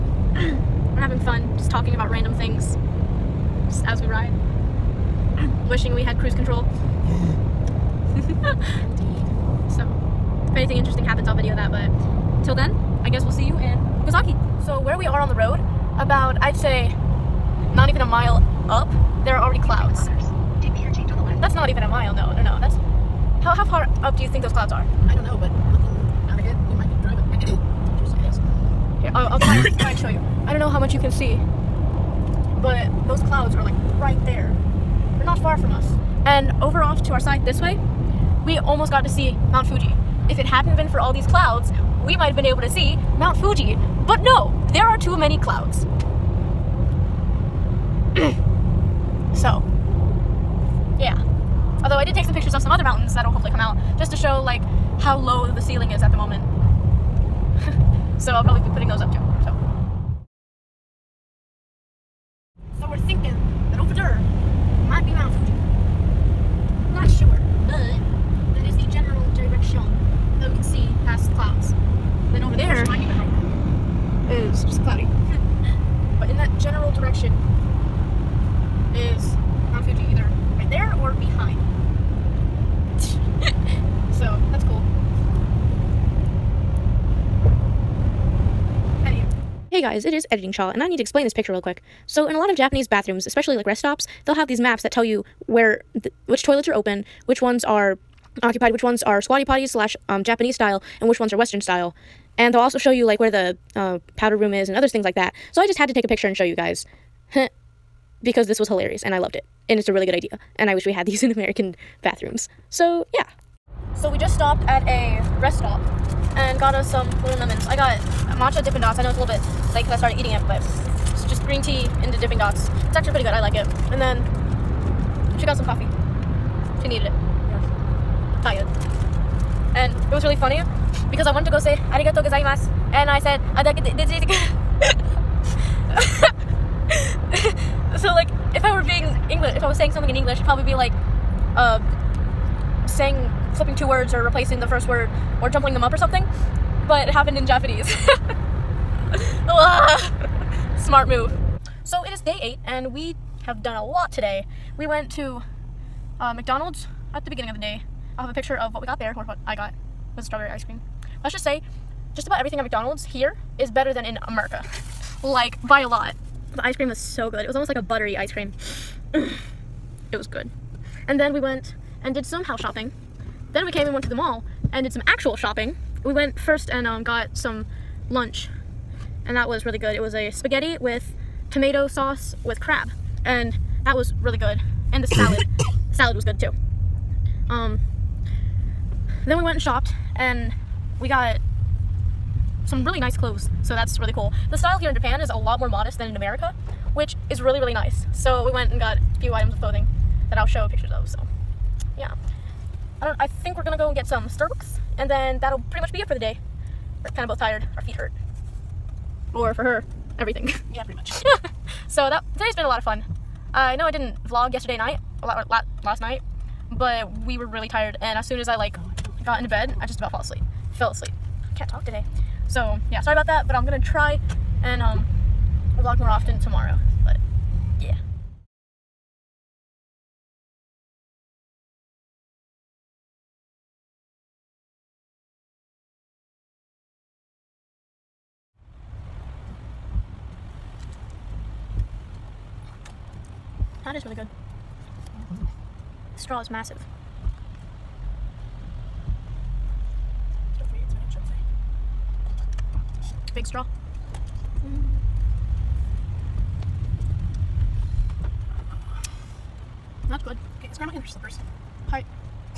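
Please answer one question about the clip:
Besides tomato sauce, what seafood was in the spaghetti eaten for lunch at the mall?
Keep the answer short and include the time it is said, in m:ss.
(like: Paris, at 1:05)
Crab, at 3:02.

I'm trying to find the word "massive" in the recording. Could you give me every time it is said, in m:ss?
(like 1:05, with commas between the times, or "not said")
4:06.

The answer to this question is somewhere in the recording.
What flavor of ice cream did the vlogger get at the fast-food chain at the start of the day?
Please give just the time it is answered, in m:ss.
2:40.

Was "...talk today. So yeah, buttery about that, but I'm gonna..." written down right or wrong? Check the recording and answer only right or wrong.
wrong.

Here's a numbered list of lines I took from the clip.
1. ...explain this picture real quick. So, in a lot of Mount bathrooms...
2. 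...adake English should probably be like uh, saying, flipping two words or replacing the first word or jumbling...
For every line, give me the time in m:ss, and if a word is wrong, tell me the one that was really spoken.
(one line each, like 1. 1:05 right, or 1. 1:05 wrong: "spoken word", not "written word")
1. 1:31 wrong: "Japanese", not "Mount"
2. 2:13 right.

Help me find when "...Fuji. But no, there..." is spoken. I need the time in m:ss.
0:43.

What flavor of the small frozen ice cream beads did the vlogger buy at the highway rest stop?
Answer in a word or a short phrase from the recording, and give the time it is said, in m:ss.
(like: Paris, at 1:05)
Matcha, at 1:58.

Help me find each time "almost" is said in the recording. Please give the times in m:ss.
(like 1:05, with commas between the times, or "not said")
0:38, 2:47.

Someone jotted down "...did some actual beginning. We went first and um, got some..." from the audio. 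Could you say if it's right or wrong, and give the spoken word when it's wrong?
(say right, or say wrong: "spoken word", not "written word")
wrong: "shopping", not "beginning".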